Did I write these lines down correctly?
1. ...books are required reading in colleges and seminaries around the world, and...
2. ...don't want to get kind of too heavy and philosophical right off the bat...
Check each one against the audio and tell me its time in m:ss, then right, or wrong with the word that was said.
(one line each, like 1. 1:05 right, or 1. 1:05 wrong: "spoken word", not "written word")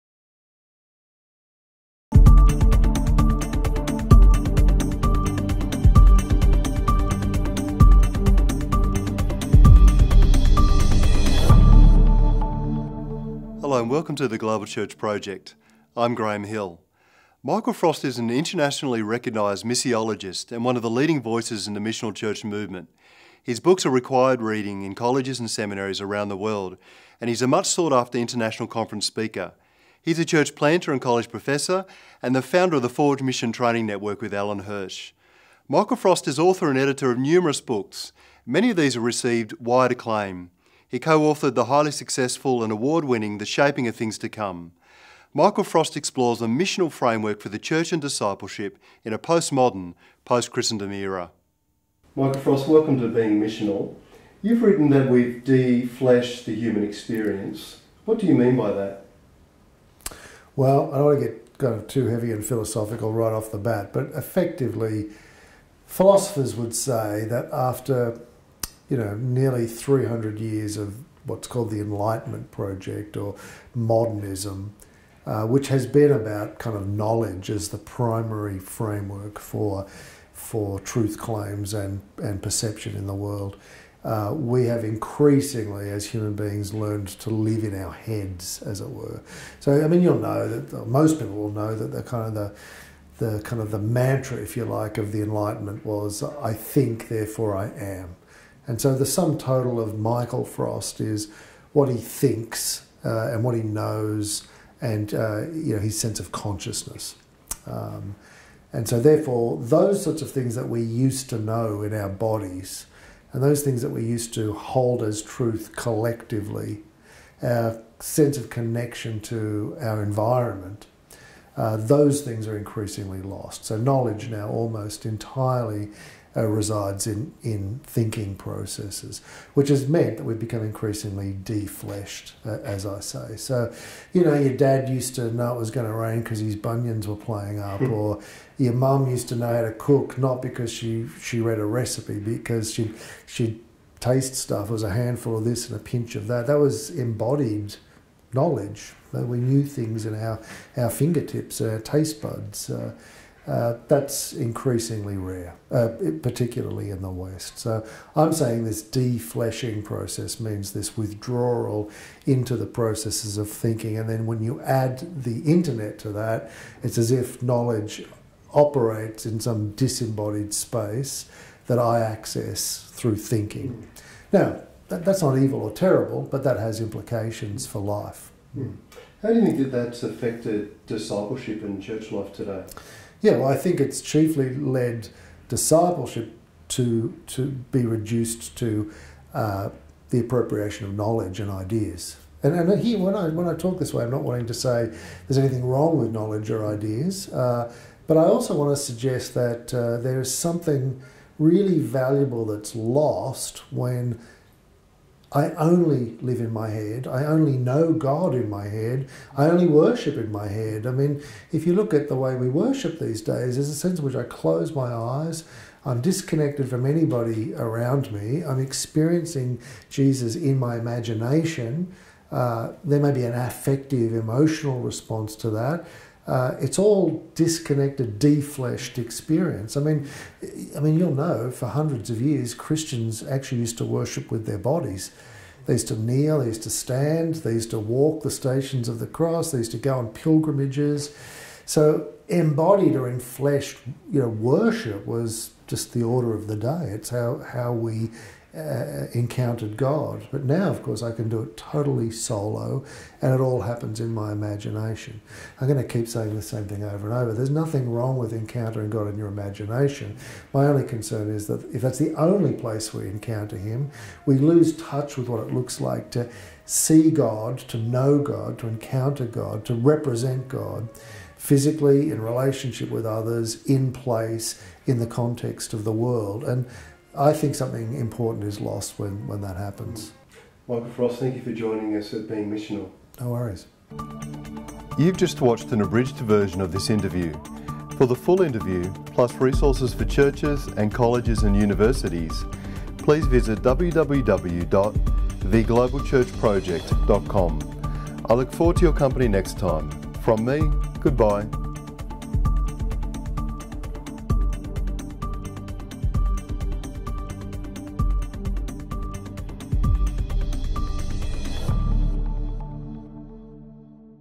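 1. 0:23 right
2. 1:00 right.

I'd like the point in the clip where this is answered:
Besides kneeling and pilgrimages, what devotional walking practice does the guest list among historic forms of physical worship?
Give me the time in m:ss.
3:58.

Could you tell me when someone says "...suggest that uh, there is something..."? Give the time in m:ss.
3:18.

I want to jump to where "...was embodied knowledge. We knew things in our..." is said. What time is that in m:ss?
2:26.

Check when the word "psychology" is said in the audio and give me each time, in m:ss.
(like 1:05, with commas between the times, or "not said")
not said.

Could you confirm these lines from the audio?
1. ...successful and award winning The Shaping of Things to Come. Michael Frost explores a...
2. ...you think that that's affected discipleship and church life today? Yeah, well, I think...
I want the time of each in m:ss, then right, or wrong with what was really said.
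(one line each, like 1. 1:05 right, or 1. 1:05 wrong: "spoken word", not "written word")
1. 0:41 right
2. 2:59 right.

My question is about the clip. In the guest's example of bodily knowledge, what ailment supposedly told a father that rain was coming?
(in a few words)
Bunions.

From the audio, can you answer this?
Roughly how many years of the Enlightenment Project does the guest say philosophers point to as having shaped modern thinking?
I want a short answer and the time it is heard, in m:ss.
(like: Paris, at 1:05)
300, at 1:09.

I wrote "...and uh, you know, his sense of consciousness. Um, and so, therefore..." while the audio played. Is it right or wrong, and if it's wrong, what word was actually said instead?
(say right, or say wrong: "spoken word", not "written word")
right.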